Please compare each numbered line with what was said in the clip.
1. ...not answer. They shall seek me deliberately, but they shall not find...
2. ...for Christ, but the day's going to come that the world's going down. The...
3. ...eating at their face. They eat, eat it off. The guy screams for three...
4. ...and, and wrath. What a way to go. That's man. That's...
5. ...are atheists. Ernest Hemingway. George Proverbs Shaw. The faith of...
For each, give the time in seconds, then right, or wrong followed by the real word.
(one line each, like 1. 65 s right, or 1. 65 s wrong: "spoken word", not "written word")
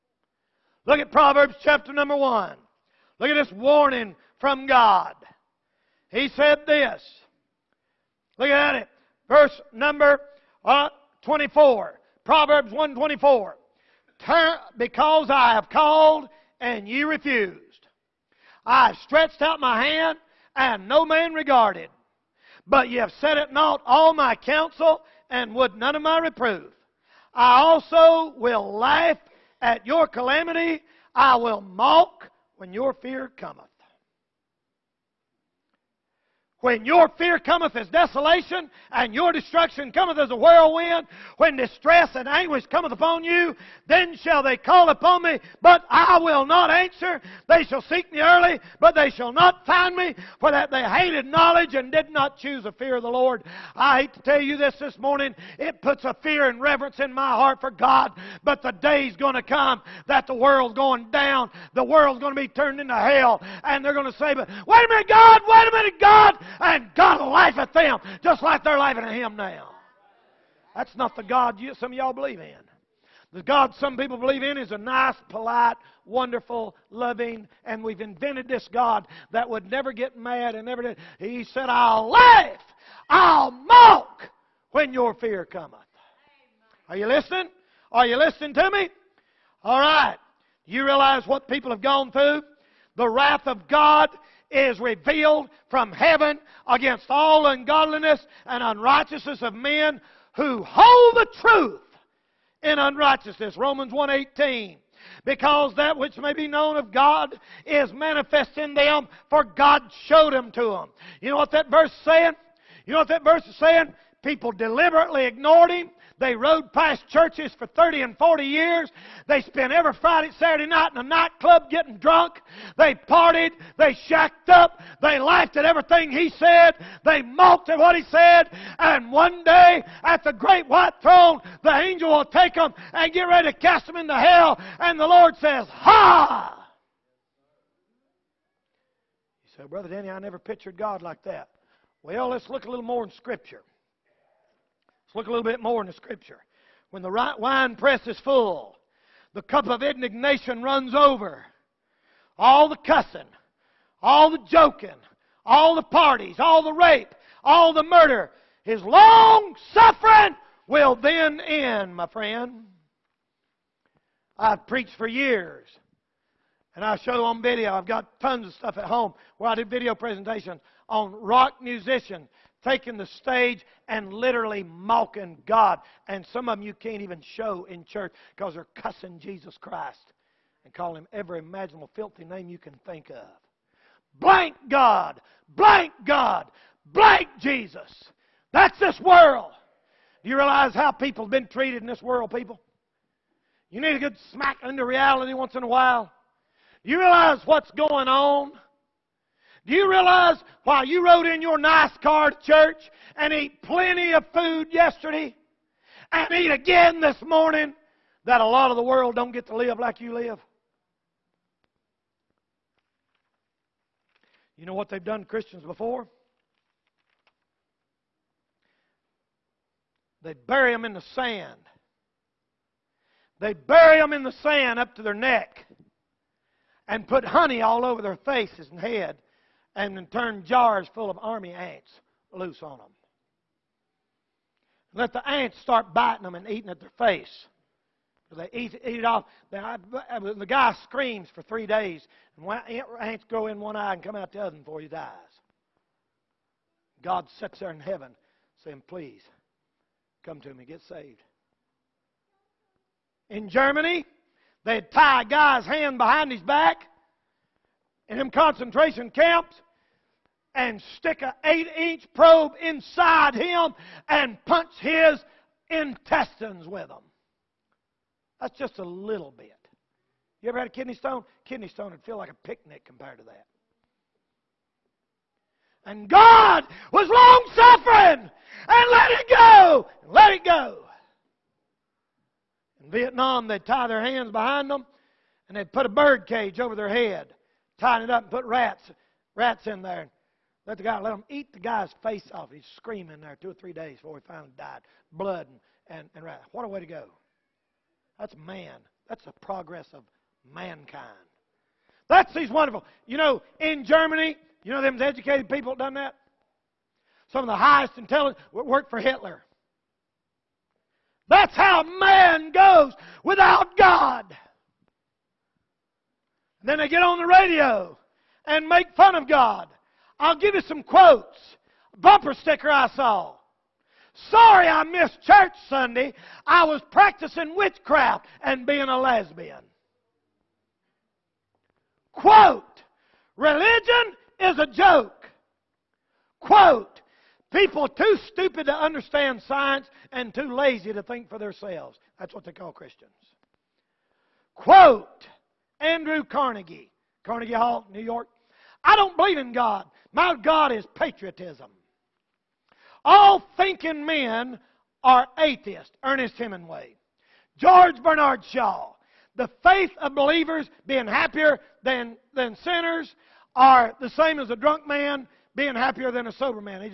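1. 46 s wrong: "early", not "deliberately"
2. 57 s wrong: "God", not "Christ"
3. 236 s right
4. 295 s right
5. 355 s wrong: "Bernard", not "Proverbs".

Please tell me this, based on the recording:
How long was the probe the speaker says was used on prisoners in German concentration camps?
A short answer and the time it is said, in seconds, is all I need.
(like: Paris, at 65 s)
8 inches, at 261 s.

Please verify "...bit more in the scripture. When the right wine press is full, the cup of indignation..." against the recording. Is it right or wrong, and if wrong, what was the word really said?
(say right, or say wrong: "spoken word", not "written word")
right.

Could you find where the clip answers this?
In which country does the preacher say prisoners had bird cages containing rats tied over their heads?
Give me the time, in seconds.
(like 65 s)
282 s.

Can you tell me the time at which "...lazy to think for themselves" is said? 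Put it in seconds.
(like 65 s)
340 s.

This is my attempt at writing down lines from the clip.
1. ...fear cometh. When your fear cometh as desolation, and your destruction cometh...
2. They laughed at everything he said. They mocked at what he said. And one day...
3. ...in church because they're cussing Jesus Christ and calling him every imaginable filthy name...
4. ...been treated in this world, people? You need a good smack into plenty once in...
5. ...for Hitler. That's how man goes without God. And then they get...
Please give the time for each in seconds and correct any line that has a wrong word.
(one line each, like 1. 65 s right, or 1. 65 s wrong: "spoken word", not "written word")
1. 32 s right
2. 124 s right
3. 177 s right
4. 191 s wrong: "reality", not "plenty"
5. 308 s right.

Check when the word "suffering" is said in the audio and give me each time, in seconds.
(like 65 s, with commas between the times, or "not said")
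159 s, 277 s.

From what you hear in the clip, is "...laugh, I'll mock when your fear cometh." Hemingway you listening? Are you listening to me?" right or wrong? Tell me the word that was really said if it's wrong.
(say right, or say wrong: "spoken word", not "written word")
wrong: "Are", not "Hemingway".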